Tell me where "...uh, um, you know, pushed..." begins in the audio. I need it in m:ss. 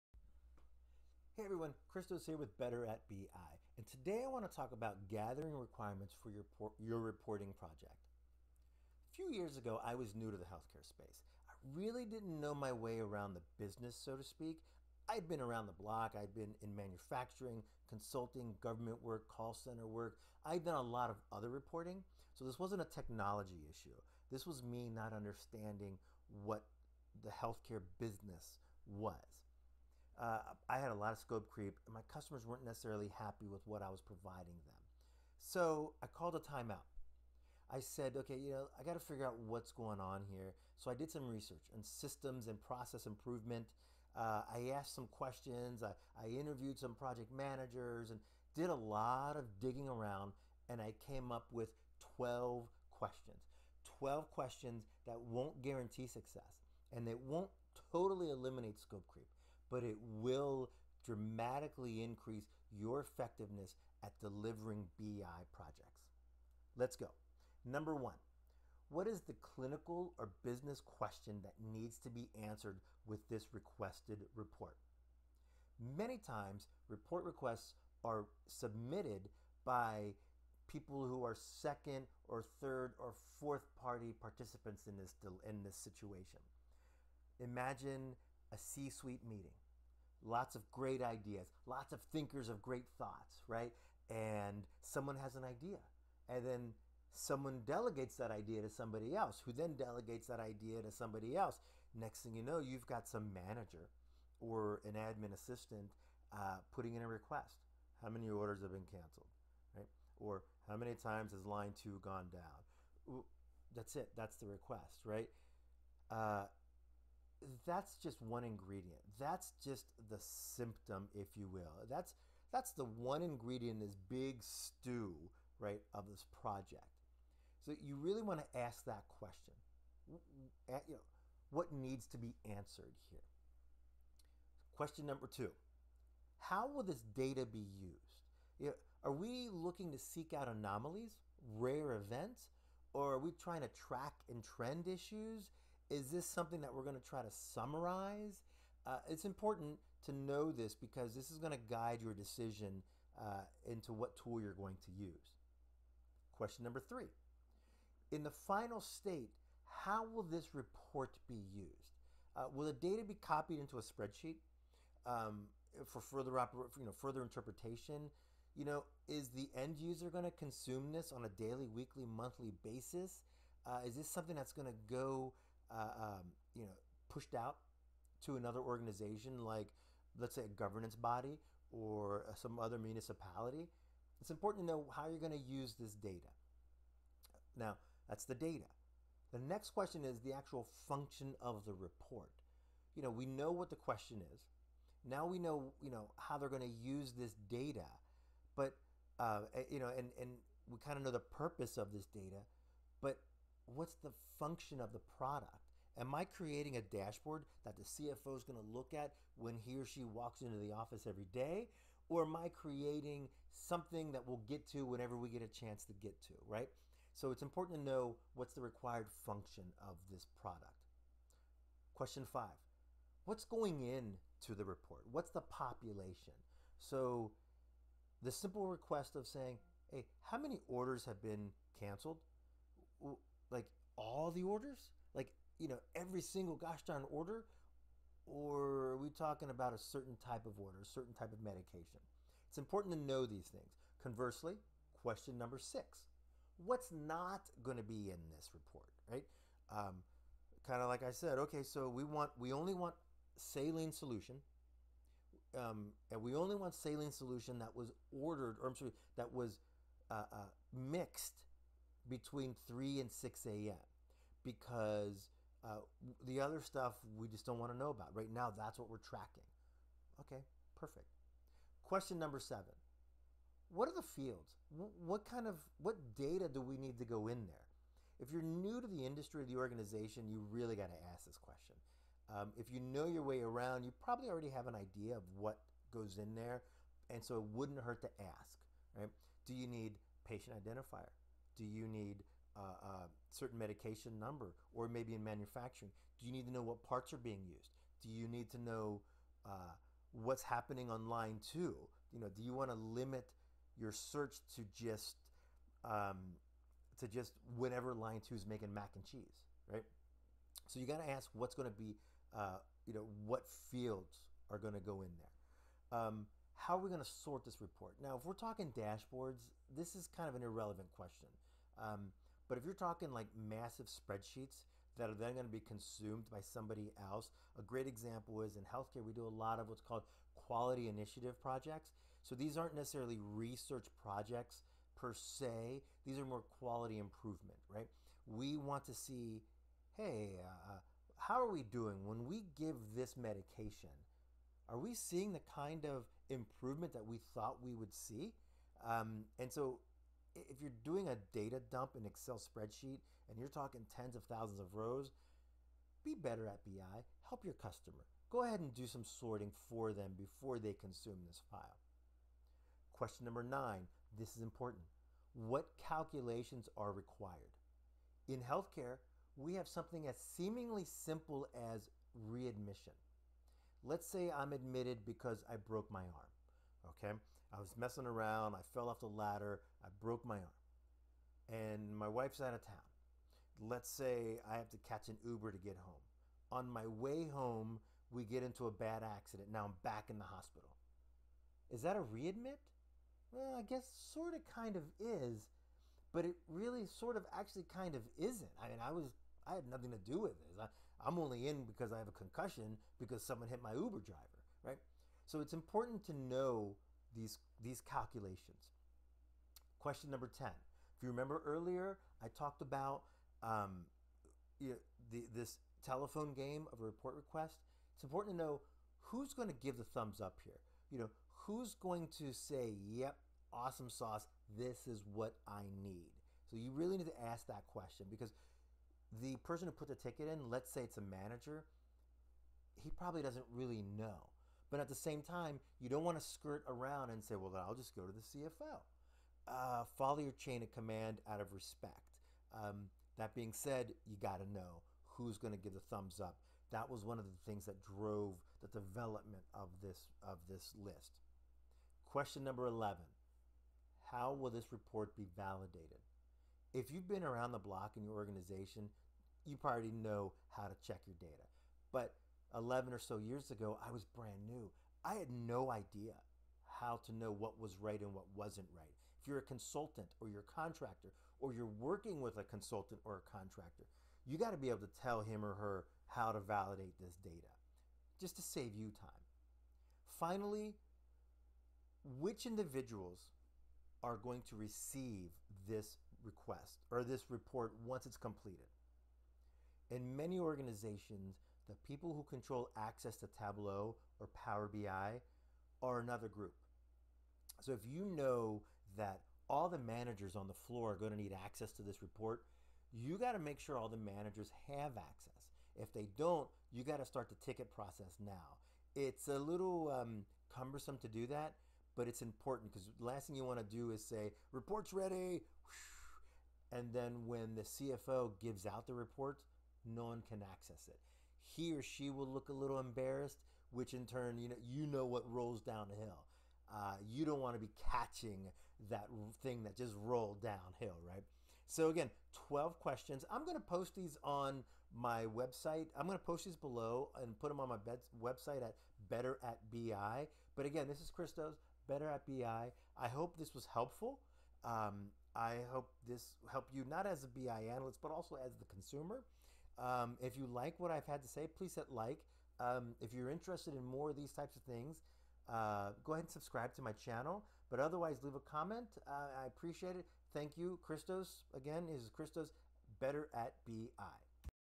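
2:55.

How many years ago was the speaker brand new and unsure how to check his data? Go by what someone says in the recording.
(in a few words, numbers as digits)
11.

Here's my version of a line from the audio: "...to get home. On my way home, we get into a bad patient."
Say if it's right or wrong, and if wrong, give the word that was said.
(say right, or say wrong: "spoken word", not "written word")
wrong: "accident", not "patient".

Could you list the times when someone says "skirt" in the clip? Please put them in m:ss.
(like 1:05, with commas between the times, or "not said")
7:16.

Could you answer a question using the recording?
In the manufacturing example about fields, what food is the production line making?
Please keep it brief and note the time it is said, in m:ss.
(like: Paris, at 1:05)
Mac and cheese, at 5:08.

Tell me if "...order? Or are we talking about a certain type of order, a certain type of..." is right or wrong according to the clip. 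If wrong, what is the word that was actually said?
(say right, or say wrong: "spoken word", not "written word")
right.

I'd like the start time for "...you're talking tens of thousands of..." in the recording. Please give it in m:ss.
5:53.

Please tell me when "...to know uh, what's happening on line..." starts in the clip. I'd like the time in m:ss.
4:58.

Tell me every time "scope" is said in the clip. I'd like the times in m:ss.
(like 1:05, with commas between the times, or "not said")
0:31, 0:58.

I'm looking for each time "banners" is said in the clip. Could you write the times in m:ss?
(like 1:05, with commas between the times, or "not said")
not said.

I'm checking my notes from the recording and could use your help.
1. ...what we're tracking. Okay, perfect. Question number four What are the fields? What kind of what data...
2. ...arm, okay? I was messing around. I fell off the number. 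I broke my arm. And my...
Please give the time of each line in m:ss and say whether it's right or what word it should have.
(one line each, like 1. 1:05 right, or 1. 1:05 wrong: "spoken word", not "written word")
1. 4:28 wrong: "seven", not "four"
2. 6:16 wrong: "ladder", not "number".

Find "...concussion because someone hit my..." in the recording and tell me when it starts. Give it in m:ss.
6:42.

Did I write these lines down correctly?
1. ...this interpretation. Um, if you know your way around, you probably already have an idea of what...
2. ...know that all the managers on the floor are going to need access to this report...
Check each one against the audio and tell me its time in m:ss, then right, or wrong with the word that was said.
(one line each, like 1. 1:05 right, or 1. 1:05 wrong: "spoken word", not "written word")
1. 4:41 wrong: "question", not "interpretation"
2. 8:18 right.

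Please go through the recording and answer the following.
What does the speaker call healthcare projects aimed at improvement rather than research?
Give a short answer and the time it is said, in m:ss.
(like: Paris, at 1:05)
Quality initiative projects, at 5:30.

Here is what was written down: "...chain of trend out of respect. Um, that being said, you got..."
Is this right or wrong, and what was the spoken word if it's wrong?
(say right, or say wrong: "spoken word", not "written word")
wrong: "command", not "trend".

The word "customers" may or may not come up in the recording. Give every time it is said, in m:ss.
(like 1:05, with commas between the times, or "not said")
0:32, 5:57.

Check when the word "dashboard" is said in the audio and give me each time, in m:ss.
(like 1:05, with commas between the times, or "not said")
3:26, 5:18.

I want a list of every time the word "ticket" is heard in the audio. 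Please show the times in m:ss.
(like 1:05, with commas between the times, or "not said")
7:09, 8:27.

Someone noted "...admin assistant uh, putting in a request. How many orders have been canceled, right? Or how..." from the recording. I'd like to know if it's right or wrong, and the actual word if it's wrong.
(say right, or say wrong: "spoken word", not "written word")
right.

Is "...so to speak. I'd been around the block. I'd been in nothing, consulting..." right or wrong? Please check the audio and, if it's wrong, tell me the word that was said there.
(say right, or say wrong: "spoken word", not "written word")
wrong: "manufacturing", not "nothing".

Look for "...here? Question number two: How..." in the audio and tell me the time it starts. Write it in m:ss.
2:13.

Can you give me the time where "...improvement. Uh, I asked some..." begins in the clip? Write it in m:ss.
0:43.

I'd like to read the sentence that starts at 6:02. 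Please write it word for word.
Question number nine, this is important.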